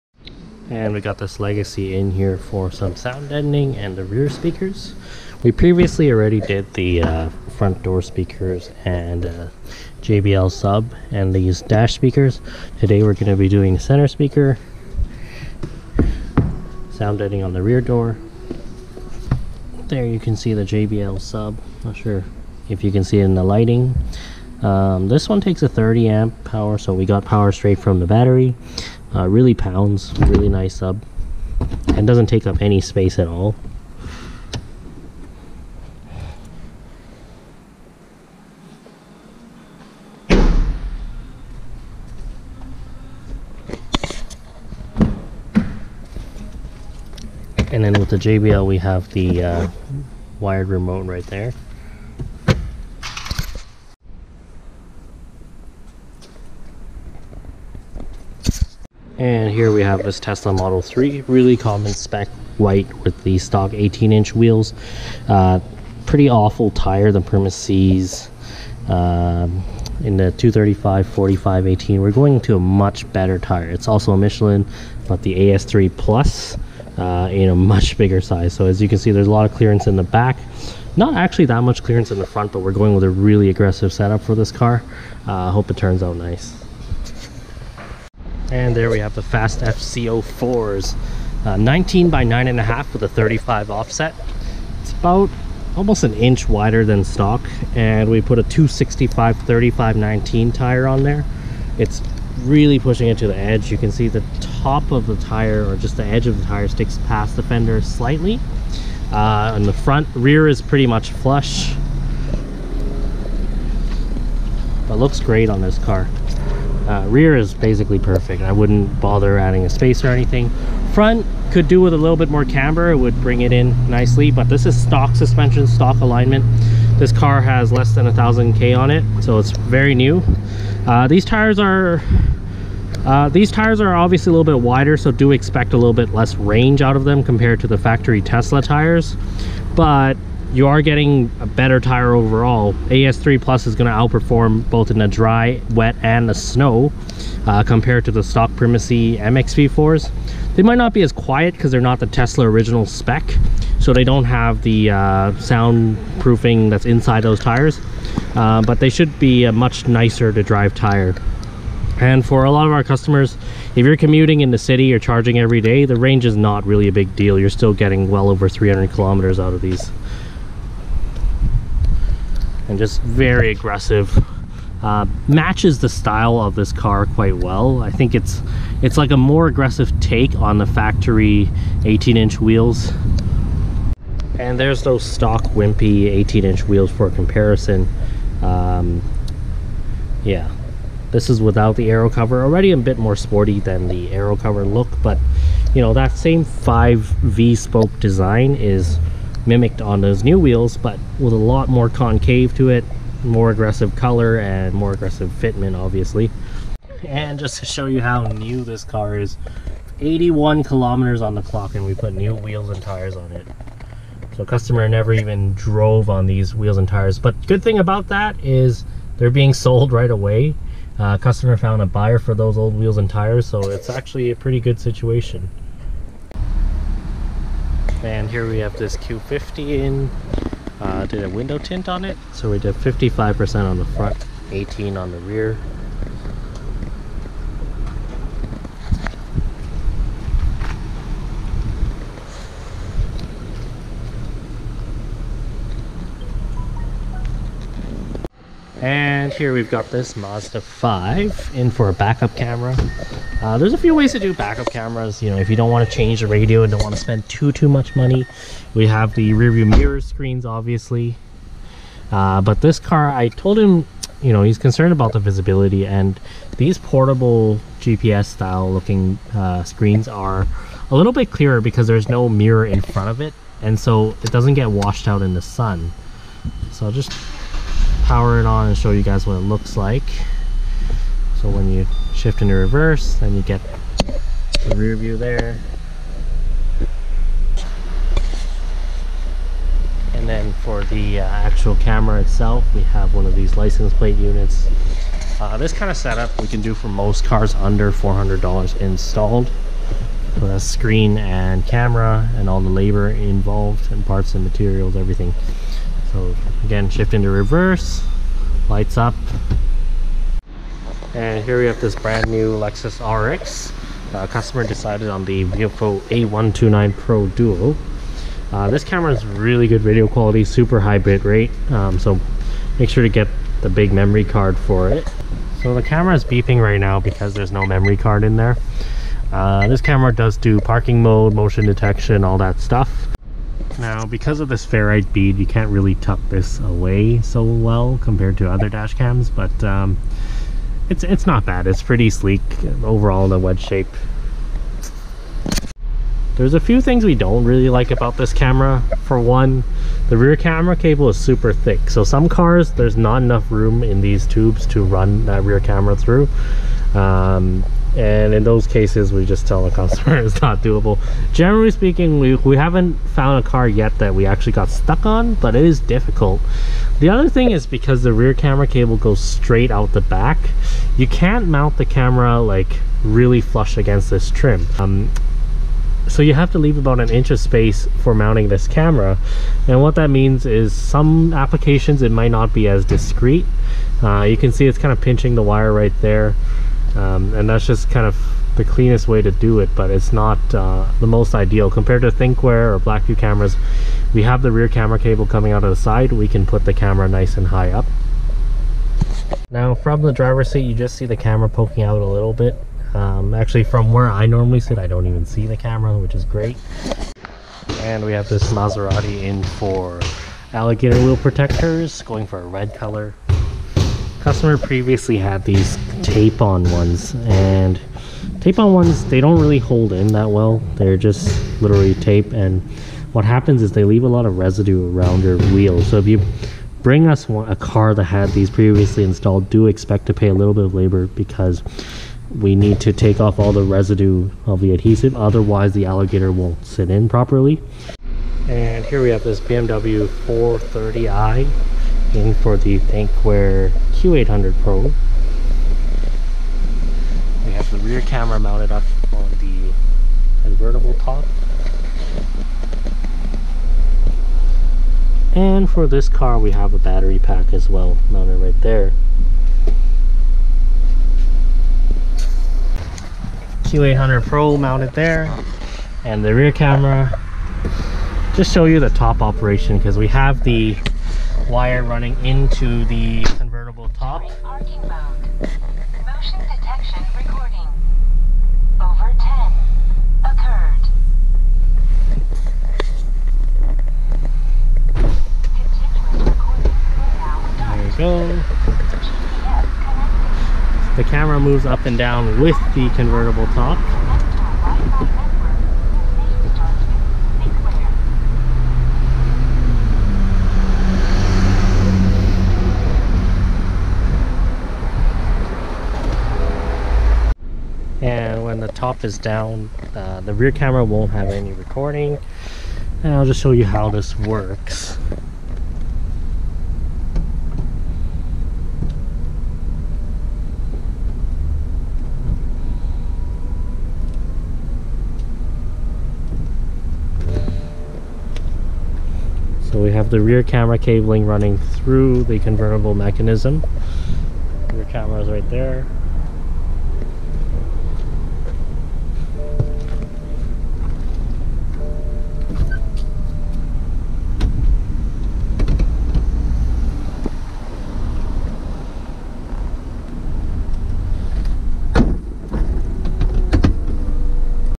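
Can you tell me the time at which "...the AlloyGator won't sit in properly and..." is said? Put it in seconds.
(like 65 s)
435 s.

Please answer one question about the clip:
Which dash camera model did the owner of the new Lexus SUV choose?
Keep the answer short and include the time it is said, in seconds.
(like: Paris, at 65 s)
Viofo A129 Pro Duo, at 315 s.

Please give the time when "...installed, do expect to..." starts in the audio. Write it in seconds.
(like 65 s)
429 s.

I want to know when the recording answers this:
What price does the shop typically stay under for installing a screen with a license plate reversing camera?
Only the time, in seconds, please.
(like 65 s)
297 s.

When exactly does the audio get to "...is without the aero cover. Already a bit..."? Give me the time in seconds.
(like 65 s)
191 s.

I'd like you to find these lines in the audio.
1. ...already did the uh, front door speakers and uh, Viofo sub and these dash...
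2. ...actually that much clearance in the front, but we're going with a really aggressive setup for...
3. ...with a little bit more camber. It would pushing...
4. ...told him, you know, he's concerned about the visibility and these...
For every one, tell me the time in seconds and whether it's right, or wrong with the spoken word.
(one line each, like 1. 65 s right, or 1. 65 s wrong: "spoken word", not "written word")
1. 6 s wrong: "JBL", not "Viofo"
2. 81 s right
3. 121 s wrong: "bring", not "pushing"
4. 263 s right.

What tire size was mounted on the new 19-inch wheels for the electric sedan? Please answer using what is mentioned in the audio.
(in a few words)
265 35 19.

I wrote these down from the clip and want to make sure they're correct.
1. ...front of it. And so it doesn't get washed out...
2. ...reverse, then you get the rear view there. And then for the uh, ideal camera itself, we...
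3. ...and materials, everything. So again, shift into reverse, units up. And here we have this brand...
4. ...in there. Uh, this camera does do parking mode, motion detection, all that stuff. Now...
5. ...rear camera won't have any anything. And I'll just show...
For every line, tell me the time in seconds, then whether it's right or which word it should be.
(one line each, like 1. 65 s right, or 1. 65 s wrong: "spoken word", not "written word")
1. 272 s right
2. 282 s wrong: "actual", not "ideal"
3. 304 s wrong: "lights", not "units"
4. 328 s right
5. 510 s wrong: "recording", not "anything".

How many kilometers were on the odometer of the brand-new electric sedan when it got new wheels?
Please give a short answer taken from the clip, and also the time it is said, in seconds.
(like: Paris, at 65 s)
81, at 209 s.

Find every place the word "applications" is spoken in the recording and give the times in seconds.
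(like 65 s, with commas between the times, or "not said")
381 s.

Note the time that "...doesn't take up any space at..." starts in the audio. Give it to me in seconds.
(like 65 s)
32 s.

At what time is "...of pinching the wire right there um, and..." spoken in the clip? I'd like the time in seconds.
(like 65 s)
384 s.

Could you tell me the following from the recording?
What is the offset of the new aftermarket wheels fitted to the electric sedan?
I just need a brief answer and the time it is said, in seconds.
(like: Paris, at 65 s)
35, at 93 s.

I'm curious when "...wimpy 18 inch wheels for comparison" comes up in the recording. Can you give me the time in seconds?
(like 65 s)
185 s.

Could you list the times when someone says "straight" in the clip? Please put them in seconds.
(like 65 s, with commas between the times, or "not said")
27 s, 369 s.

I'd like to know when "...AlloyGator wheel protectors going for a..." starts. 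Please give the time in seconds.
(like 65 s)
410 s.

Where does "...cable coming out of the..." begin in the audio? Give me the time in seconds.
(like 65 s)
394 s.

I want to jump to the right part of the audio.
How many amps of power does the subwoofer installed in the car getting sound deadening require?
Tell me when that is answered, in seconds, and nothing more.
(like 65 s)
25 s.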